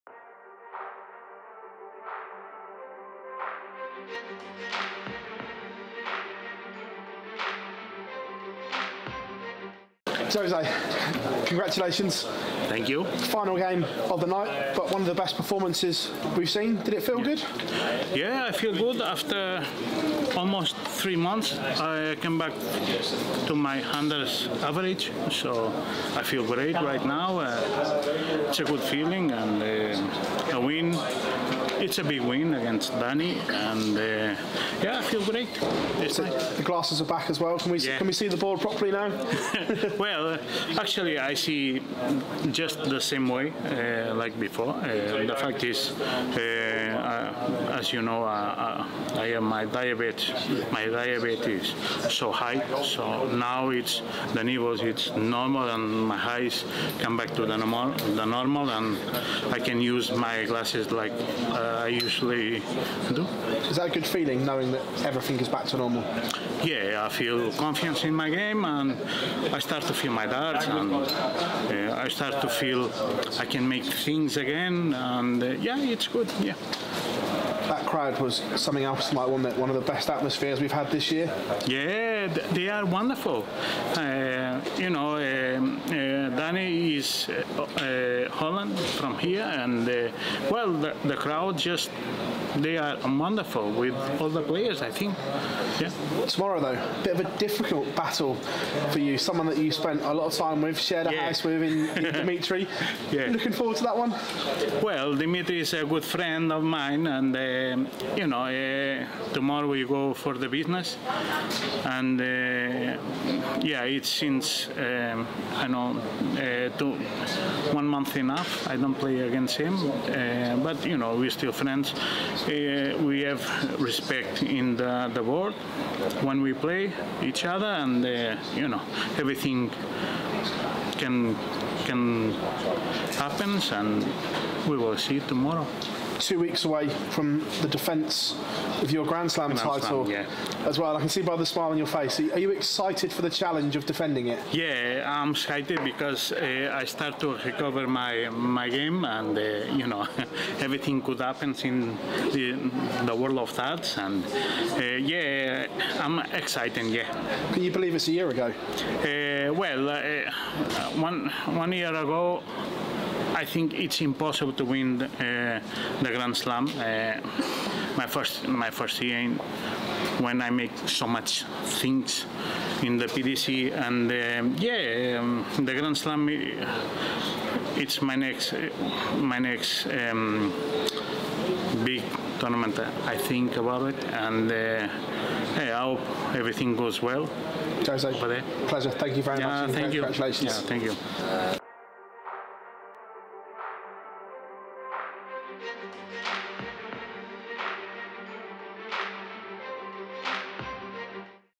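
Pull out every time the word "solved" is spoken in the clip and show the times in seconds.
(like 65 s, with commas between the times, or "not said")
not said.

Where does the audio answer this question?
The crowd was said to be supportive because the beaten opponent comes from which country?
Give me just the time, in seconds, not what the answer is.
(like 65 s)
88 s.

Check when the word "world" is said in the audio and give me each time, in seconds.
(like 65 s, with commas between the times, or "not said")
125 s, 153 s.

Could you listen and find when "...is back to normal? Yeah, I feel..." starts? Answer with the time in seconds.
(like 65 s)
65 s.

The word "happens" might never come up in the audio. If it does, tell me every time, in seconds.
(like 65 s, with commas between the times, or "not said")
133 s, 151 s.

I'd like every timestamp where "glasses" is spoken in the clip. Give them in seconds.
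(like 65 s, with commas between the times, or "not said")
36 s, 60 s.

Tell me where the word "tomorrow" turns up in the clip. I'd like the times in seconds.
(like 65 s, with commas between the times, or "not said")
96 s, 109 s, 135 s.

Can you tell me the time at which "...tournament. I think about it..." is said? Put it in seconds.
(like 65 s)
182 s.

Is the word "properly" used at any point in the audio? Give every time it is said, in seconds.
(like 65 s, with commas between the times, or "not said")
38 s.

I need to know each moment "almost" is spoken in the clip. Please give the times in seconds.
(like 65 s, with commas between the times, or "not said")
20 s.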